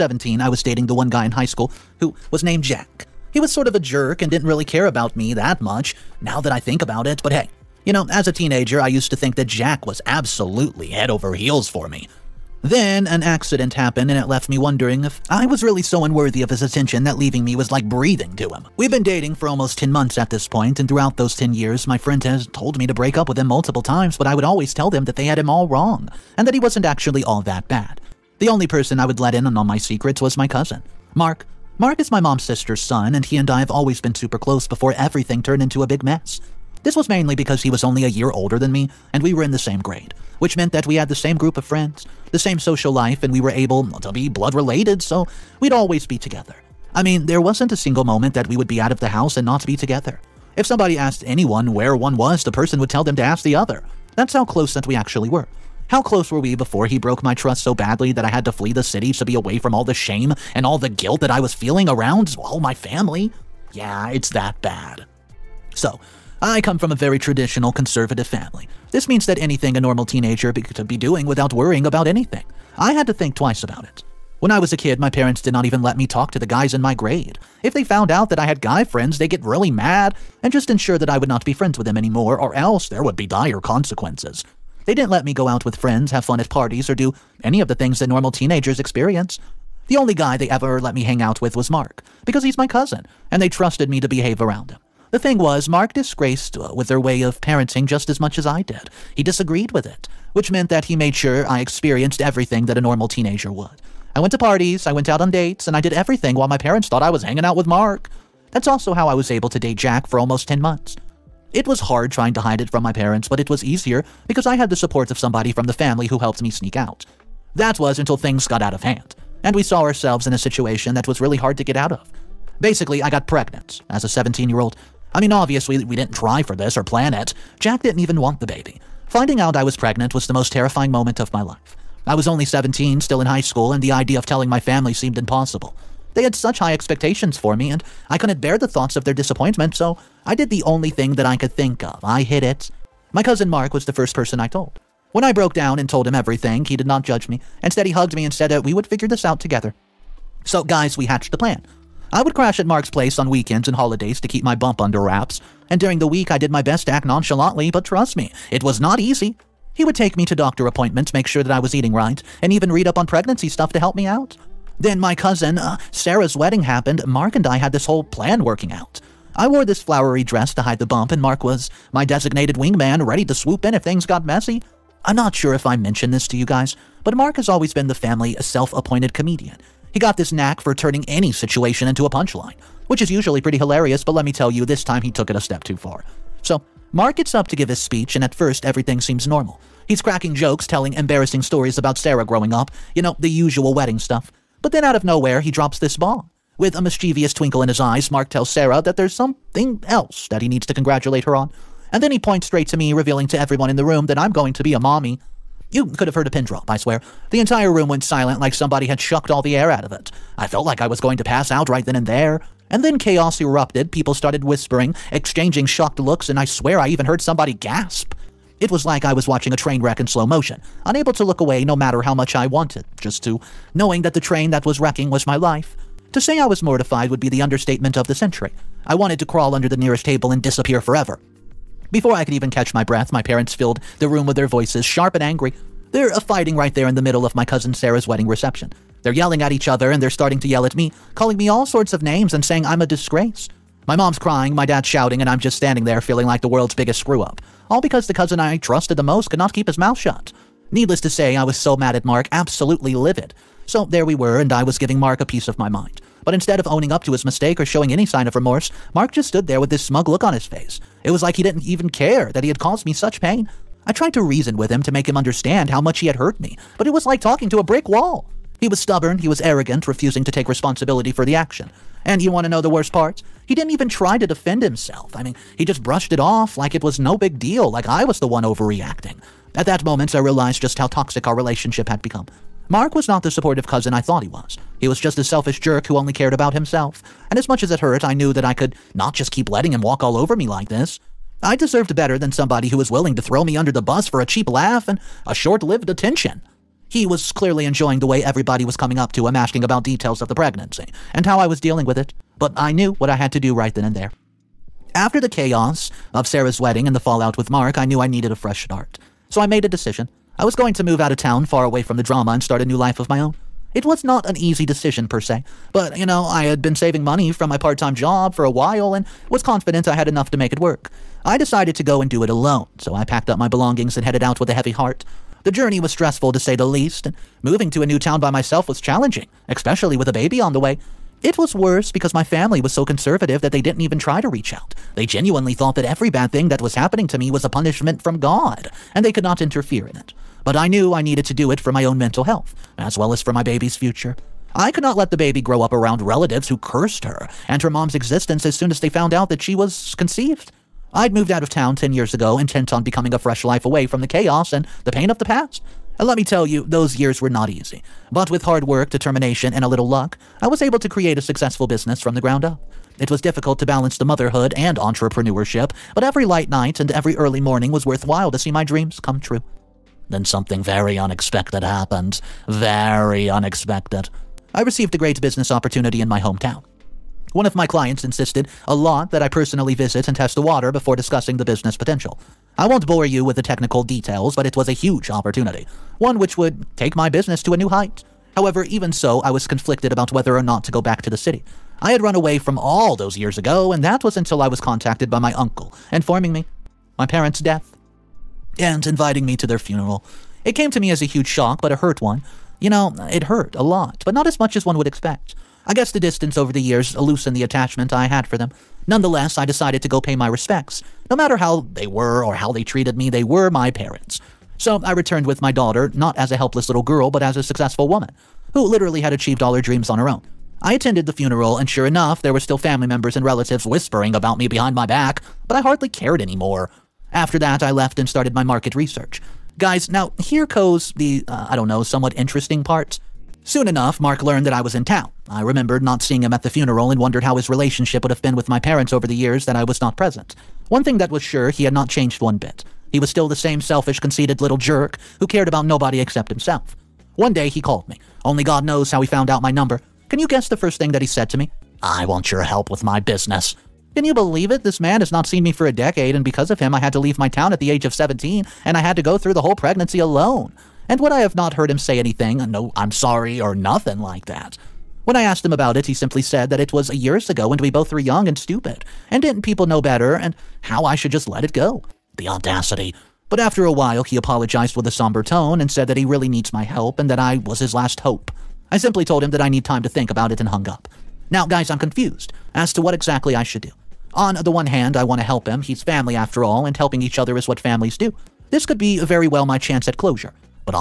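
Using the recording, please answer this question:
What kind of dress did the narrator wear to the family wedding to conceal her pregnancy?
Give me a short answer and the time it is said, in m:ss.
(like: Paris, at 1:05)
Flowery dress, at 2:49.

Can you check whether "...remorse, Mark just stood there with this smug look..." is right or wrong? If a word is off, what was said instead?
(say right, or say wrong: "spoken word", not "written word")
right.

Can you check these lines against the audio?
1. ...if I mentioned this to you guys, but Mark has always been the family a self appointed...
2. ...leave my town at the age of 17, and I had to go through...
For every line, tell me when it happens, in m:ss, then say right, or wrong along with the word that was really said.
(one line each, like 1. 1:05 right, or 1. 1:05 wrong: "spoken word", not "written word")
1. 2:55 right
2. 7:36 right.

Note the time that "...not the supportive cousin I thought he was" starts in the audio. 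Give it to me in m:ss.
4:43.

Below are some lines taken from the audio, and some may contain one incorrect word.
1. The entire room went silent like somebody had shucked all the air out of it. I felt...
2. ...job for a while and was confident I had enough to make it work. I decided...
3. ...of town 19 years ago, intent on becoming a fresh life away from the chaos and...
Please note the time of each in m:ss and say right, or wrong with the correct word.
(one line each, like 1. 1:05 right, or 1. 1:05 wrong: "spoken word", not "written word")
1. 3:27 right
2. 5:17 right
3. 5:51 wrong: "10", not "19".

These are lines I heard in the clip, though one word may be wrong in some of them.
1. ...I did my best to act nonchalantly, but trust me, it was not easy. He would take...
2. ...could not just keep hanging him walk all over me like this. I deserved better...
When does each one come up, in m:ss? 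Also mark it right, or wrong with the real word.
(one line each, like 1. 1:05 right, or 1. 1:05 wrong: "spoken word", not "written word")
1. 2:36 right
2. 4:48 wrong: "letting", not "hanging".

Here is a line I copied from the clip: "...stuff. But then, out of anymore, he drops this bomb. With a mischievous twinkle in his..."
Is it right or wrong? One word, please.
wrong.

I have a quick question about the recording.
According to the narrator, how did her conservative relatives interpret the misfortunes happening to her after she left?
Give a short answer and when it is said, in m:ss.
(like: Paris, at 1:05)
Punishment from God, at 5:37.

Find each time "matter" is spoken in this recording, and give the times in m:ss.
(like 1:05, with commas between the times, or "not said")
3:41, 6:51.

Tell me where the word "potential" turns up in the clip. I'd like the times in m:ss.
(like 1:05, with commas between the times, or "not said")
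6:21.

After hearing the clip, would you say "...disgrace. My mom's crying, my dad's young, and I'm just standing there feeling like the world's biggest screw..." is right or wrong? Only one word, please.
wrong.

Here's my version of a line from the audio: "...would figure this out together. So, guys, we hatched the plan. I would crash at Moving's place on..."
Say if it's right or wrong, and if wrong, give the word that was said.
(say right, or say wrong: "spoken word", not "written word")
wrong: "Mark", not "Moving".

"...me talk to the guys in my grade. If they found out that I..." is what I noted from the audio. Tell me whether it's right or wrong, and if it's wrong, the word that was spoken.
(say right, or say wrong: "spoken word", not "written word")
right.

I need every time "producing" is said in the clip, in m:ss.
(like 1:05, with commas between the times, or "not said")
not said.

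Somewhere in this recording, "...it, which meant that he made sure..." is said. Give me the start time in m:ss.
1:39.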